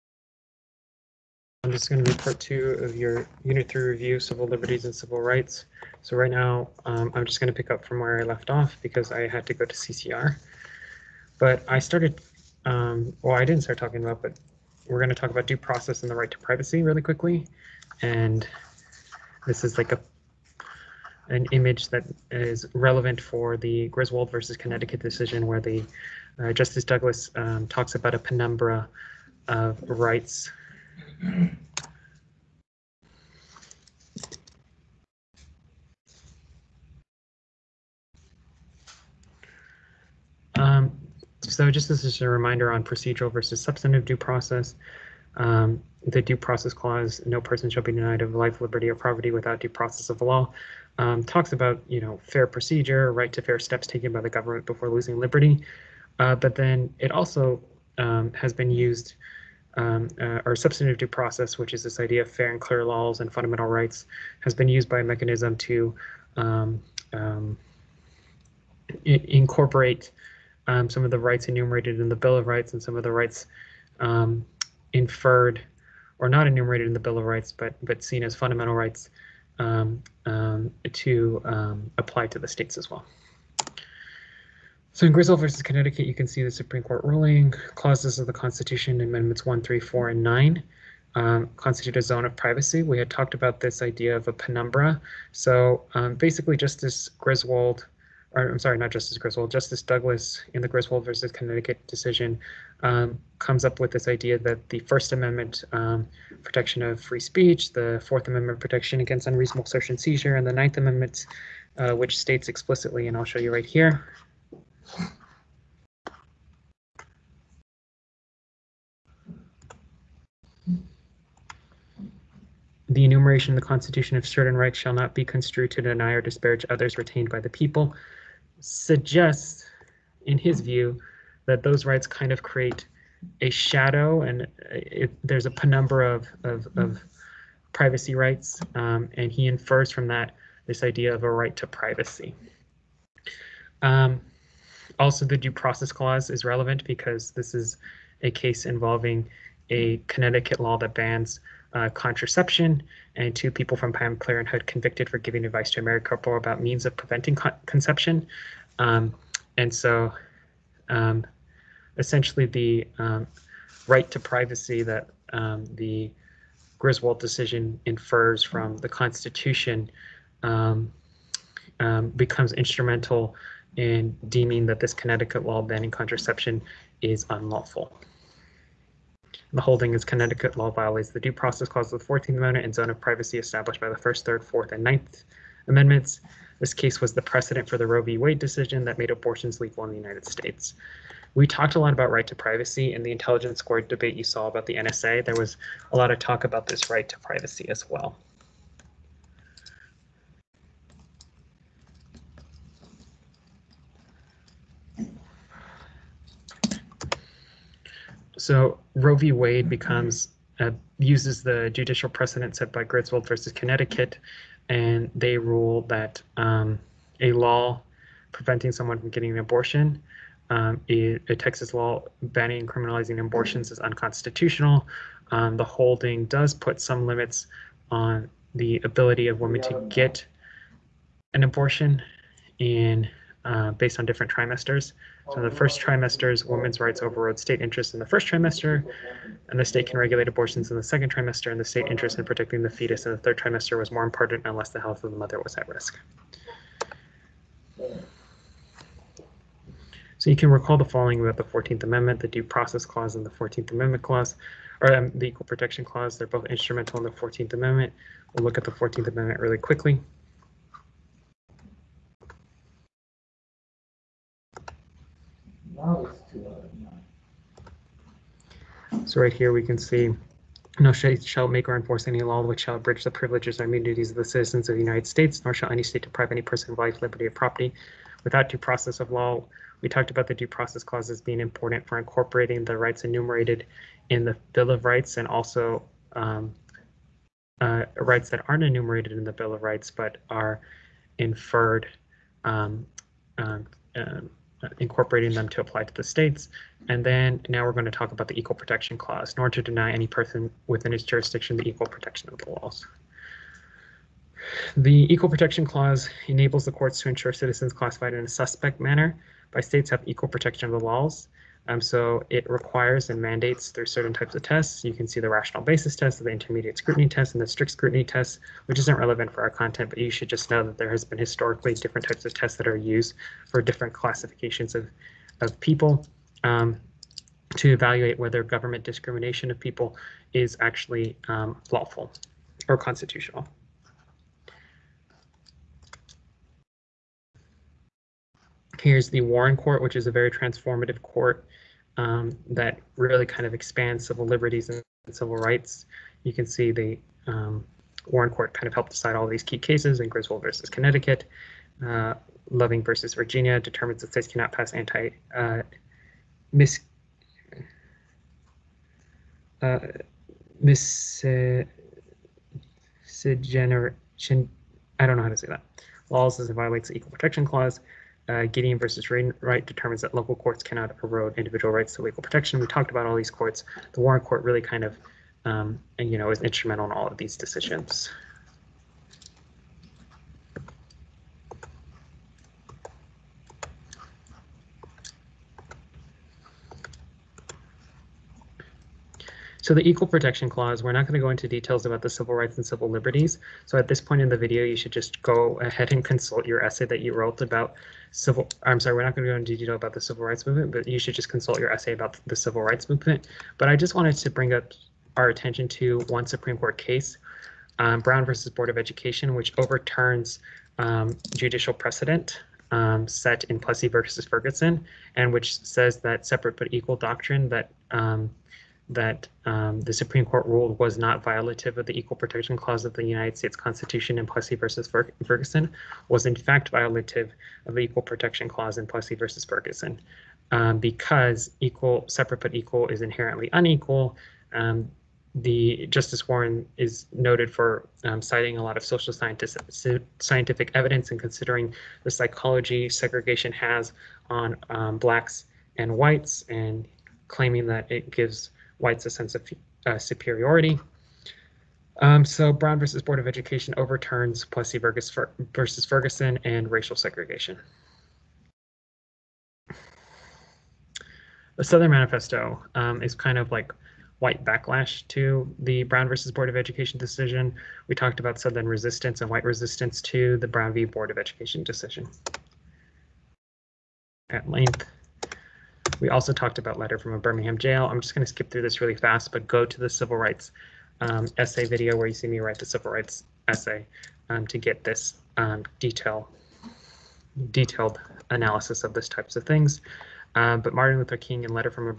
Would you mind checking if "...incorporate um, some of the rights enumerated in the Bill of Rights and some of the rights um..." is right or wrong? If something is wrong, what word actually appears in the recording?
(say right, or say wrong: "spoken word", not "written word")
right.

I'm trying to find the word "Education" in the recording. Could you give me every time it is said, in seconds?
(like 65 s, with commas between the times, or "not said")
408 s, 453 s, 466 s, 471 s.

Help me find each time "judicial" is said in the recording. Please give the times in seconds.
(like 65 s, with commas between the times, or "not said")
211 s, 411 s.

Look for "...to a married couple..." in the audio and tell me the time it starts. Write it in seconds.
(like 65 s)
155 s.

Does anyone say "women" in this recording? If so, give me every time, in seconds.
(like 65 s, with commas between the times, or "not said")
229 s, 236 s.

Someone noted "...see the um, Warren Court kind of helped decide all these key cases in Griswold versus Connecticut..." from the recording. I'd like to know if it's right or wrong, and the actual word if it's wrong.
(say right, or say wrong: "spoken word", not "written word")
right.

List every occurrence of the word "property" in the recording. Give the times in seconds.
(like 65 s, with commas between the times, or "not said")
48 s, 277 s.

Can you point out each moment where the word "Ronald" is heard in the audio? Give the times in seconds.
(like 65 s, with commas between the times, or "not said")
not said.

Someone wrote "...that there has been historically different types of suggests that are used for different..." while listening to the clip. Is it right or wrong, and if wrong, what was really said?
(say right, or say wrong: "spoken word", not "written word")
wrong: "tests", not "suggests".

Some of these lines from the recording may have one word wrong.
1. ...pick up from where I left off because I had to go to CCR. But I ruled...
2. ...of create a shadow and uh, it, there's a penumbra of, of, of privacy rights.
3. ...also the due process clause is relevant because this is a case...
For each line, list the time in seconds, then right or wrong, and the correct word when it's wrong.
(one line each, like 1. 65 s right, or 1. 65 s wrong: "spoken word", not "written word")
1. 7 s wrong: "started", not "ruled"
2. 132 s right
3. 144 s right.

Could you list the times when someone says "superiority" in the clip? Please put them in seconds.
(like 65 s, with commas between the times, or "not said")
449 s.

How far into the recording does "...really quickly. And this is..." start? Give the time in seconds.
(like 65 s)
16 s.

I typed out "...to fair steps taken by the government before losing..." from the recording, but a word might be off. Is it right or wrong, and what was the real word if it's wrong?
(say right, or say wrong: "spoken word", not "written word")
right.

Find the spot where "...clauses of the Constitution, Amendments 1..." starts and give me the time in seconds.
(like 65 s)
87 s.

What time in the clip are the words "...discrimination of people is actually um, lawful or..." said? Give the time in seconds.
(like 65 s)
328 s.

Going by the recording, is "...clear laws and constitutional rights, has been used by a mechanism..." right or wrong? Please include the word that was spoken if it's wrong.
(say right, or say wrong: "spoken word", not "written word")
wrong: "fundamental", not "constitutional".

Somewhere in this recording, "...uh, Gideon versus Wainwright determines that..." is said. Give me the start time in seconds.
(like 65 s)
368 s.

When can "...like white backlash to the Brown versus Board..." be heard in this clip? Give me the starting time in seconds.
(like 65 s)
463 s.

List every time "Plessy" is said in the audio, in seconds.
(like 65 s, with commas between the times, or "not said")
413 s, 424 s, 428 s, 454 s.